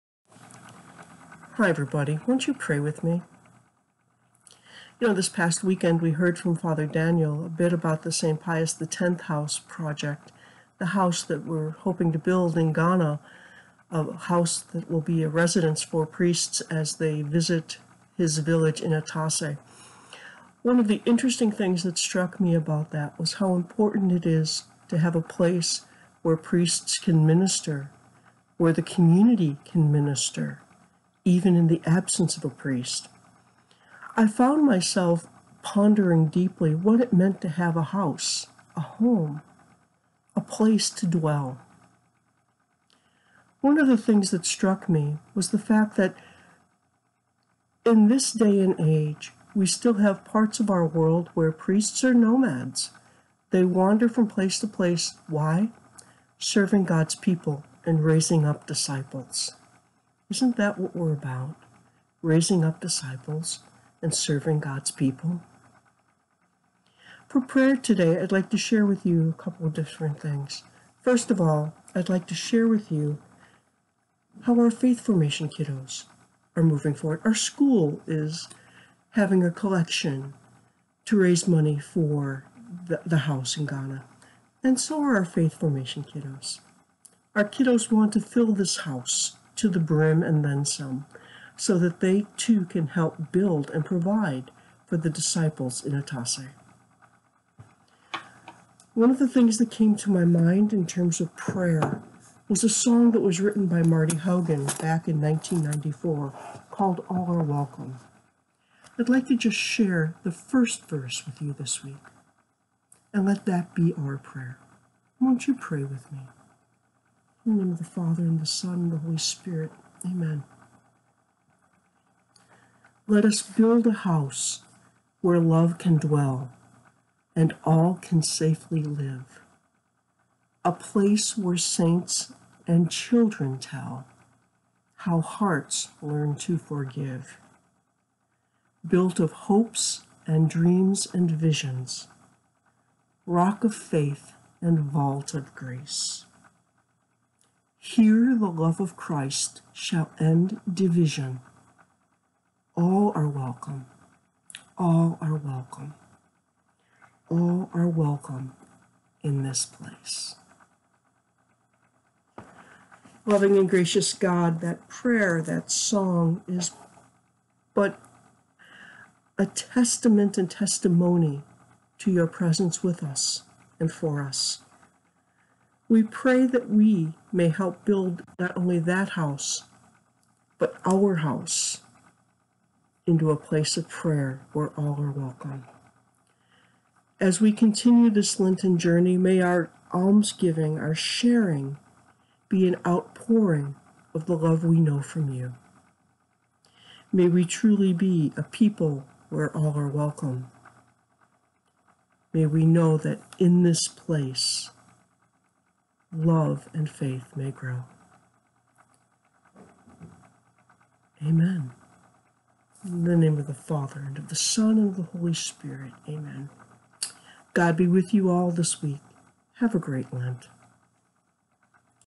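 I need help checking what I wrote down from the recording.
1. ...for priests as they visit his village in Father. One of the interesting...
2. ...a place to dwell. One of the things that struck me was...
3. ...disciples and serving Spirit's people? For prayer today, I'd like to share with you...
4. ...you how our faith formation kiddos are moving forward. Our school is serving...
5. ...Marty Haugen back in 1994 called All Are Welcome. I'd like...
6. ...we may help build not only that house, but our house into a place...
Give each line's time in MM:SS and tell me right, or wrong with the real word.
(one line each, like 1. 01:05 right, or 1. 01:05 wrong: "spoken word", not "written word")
1. 00:15 wrong: "Atase", not "Father"
2. 00:40 right
3. 01:02 wrong: "God", not "Spirit"
4. 01:12 wrong: "having", not "serving"
5. 01:43 right
6. 02:56 right.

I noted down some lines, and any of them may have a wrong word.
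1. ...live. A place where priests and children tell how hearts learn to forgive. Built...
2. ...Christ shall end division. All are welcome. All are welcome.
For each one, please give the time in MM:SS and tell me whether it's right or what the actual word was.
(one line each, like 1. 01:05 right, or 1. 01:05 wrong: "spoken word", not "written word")
1. 02:08 wrong: "saints", not "priests"
2. 02:28 right.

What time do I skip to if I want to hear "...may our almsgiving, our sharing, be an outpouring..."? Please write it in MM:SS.
03:09.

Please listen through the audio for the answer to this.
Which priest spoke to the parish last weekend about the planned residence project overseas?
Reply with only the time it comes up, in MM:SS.
00:06.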